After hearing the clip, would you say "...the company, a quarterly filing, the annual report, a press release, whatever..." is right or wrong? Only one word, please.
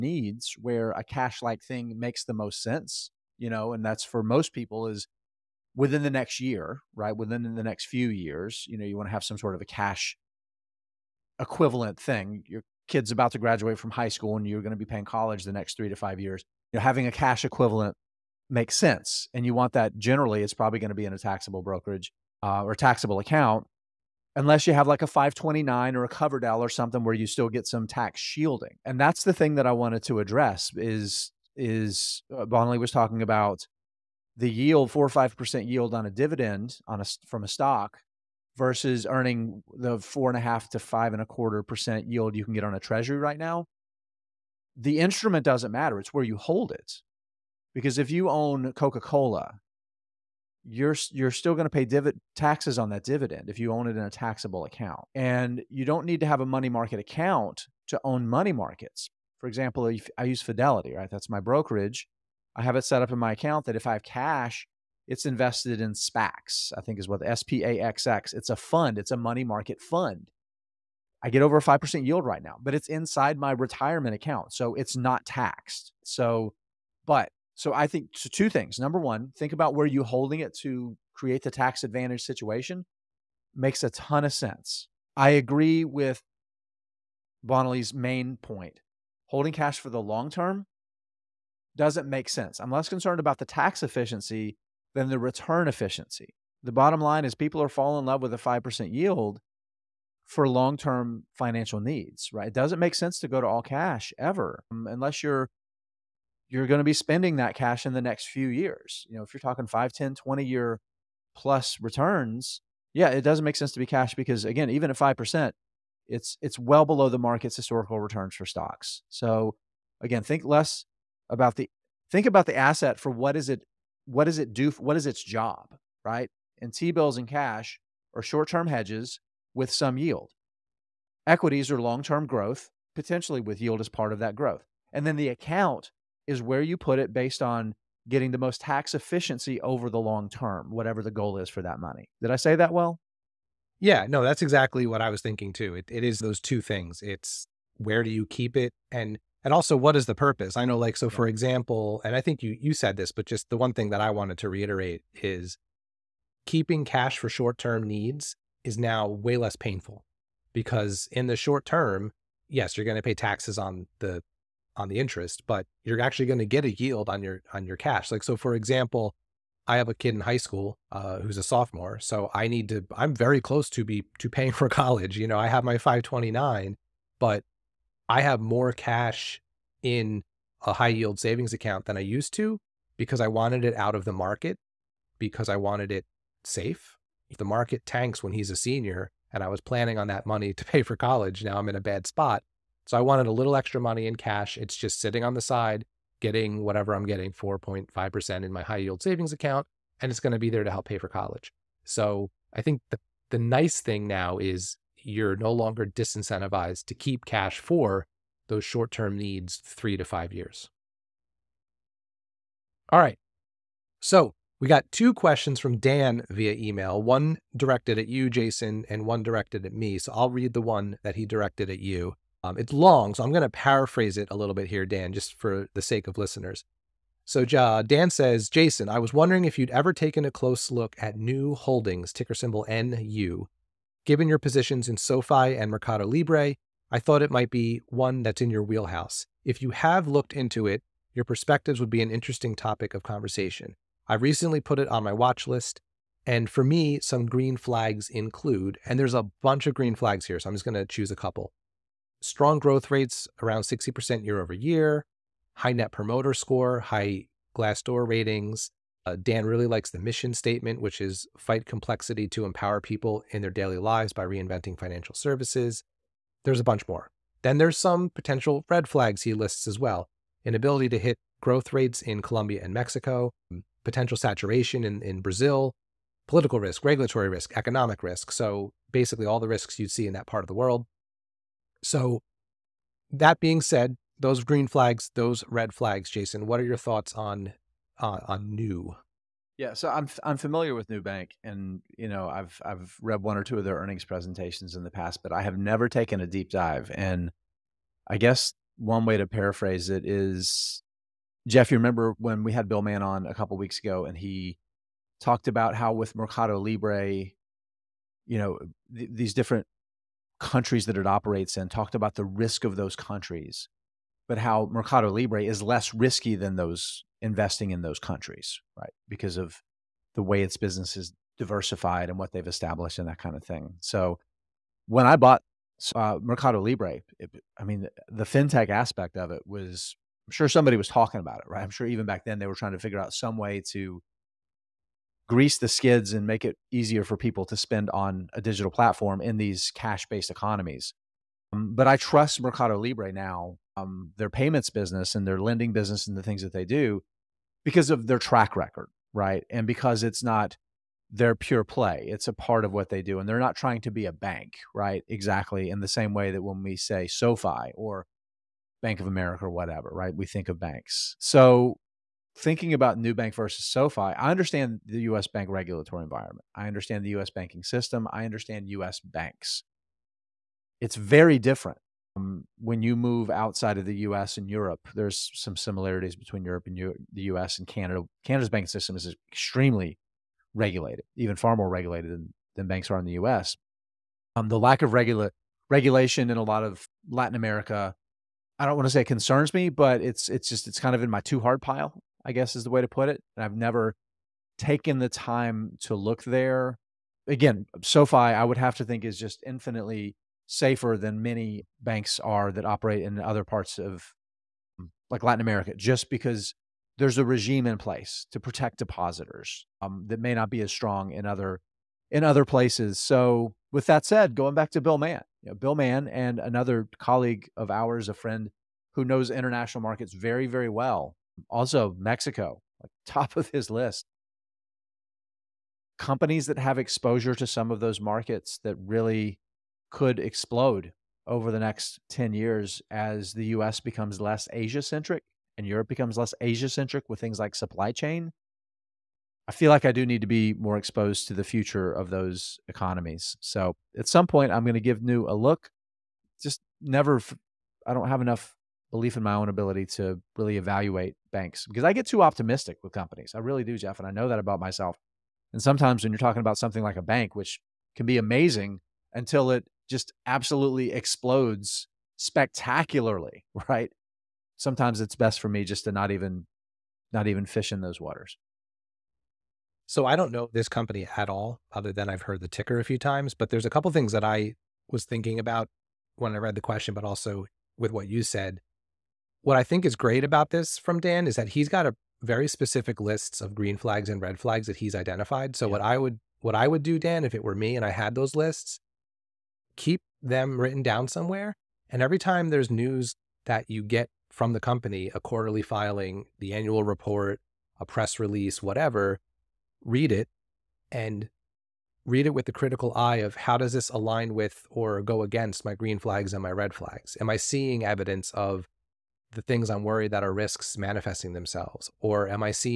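right.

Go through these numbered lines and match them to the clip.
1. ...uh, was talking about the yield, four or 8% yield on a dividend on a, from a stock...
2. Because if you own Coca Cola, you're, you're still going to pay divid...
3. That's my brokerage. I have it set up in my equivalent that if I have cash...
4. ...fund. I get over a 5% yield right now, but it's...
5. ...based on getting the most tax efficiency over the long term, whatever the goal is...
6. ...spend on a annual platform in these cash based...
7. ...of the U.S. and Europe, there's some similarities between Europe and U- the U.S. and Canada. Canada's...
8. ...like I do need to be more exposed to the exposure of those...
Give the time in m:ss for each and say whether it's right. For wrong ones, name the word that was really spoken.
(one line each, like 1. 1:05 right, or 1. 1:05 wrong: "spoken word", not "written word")
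1. 0:32 wrong: "5", not "8"
2. 0:47 right
3. 1:01 wrong: "account", not "equivalent"
4. 1:09 right
5. 2:17 right
6. 5:37 wrong: "digital", not "annual"
7. 6:13 right
8. 7:19 wrong: "future", not "exposure".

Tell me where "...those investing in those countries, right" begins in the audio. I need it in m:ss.
5:16.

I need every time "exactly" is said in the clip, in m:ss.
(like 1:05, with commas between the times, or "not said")
2:24, 5:55.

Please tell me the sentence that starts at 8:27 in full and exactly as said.
Am I seeing evidence of the things I'm worried that are risks manifesting themselves?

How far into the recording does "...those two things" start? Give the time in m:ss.
2:26.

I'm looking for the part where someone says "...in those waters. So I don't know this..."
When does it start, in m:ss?
7:47.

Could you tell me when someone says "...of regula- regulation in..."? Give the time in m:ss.
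6:24.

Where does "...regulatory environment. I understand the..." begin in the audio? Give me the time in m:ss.
6:05.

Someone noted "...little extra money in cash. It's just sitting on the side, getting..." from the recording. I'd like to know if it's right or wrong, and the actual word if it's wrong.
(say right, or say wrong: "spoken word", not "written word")
right.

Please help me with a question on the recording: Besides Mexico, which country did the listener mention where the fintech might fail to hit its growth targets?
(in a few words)
Colombia.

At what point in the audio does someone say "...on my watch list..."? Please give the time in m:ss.
4:04.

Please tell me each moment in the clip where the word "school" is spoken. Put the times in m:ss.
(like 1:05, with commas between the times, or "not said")
0:14, 2:50.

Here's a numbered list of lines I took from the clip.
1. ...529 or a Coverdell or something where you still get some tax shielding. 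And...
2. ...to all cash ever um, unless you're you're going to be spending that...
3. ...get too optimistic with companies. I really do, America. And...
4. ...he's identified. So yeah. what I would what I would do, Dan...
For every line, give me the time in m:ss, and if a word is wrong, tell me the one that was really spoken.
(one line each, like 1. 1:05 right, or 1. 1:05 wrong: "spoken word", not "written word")
1. 0:25 right
2. 1:43 right
3. 7:31 wrong: "Jeff", not "America"
4. 8:04 right.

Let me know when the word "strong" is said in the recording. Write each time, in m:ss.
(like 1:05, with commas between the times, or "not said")
4:12, 6:50.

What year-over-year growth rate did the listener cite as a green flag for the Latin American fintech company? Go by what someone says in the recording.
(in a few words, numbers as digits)
60%.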